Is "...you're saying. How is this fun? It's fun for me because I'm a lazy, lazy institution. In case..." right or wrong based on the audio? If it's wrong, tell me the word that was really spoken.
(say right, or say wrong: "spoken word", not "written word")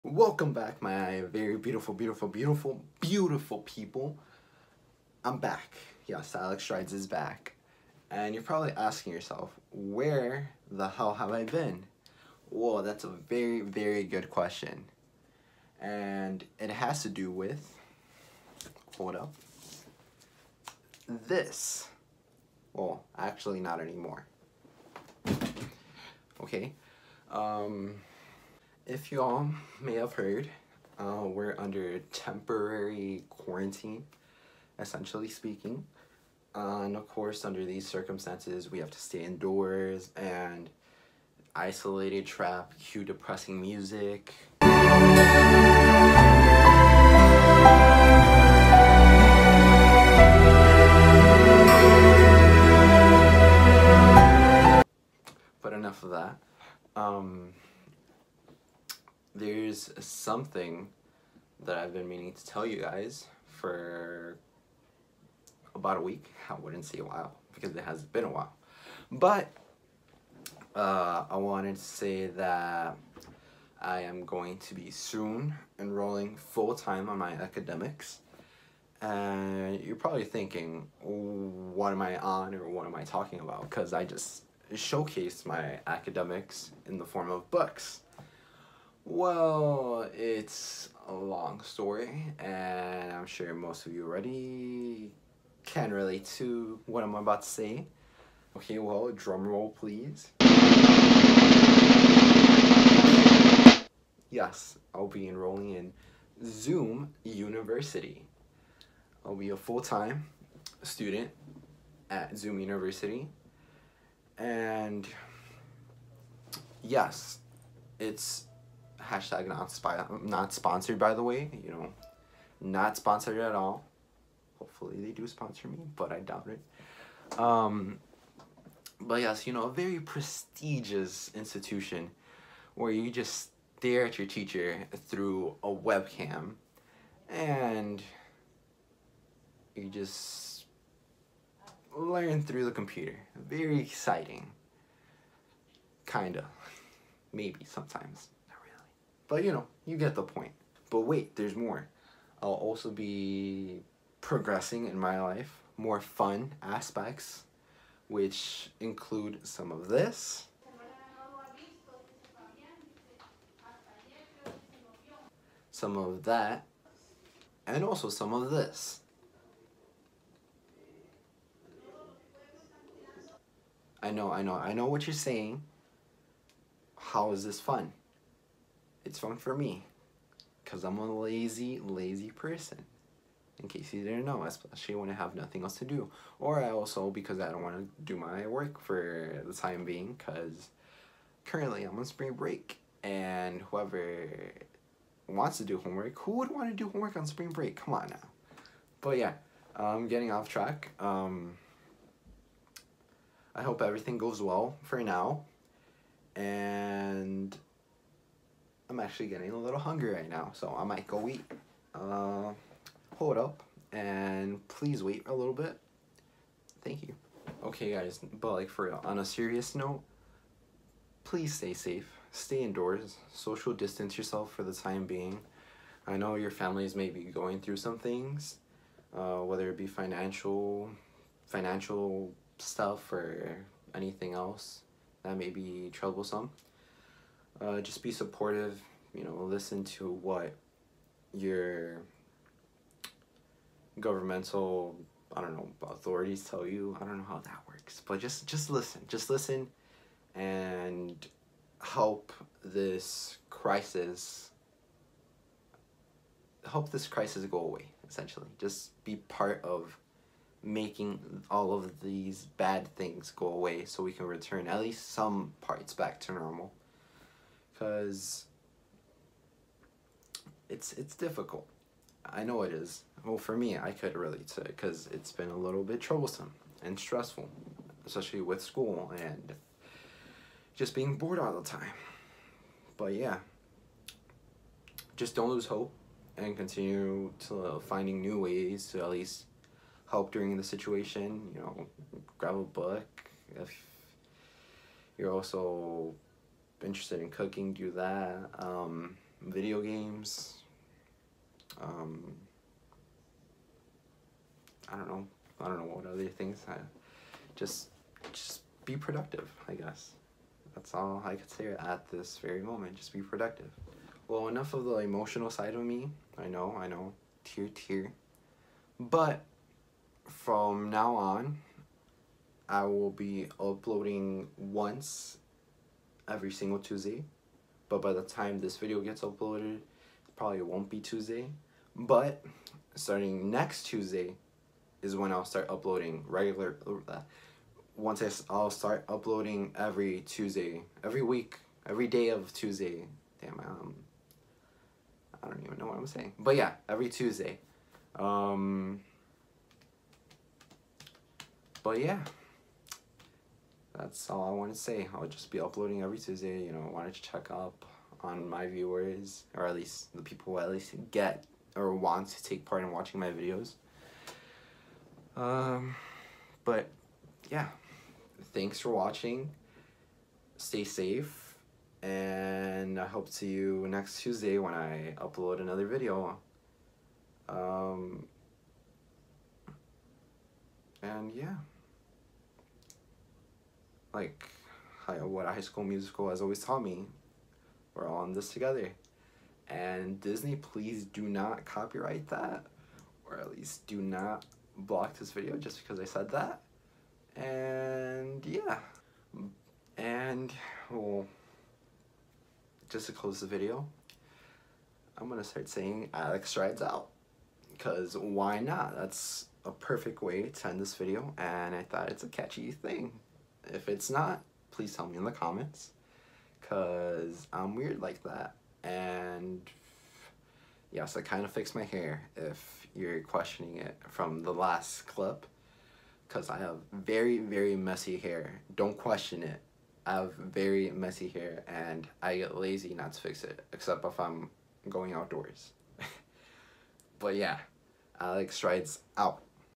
wrong: "person", not "institution".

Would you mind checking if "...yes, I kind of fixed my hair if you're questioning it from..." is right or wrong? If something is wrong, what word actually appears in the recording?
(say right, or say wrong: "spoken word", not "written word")
right.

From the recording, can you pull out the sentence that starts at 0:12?
Well, that's a very, very good question.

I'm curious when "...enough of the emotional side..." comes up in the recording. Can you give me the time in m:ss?
5:14.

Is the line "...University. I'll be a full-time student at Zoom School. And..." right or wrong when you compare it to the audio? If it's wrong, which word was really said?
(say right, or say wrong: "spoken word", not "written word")
wrong: "University", not "School".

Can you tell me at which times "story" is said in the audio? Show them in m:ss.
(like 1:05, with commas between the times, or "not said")
1:31.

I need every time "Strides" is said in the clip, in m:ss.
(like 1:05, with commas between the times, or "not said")
0:06, 6:46, 7:18.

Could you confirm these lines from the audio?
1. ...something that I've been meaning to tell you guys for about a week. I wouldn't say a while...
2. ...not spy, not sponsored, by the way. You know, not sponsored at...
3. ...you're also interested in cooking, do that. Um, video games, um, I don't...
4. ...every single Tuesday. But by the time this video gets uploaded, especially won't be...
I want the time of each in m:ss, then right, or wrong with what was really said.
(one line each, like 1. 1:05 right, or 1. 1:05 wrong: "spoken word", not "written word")
1. 0:59 right
2. 1:59 right
3. 4:55 right
4. 5:26 wrong: "probably", not "especially".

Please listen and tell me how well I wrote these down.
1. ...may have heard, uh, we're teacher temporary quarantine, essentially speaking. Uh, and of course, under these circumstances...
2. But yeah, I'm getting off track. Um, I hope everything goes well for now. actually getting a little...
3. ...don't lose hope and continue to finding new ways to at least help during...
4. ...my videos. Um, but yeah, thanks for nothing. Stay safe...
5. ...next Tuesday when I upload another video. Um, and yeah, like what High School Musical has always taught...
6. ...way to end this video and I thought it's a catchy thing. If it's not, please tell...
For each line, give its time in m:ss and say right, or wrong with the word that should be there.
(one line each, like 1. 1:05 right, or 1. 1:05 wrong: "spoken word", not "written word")
1. 0:29 wrong: "under", not "teacher"
2. 3:19 right
3. 4:45 right
4. 6:03 wrong: "watching", not "nothing"
5. 6:13 right
6. 6:50 right.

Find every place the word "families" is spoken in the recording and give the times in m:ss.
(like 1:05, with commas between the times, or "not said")
3:46.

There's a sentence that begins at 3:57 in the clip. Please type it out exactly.
Uh, just be supportive you know, listen to what your governmental, I don't know, authorities tell you.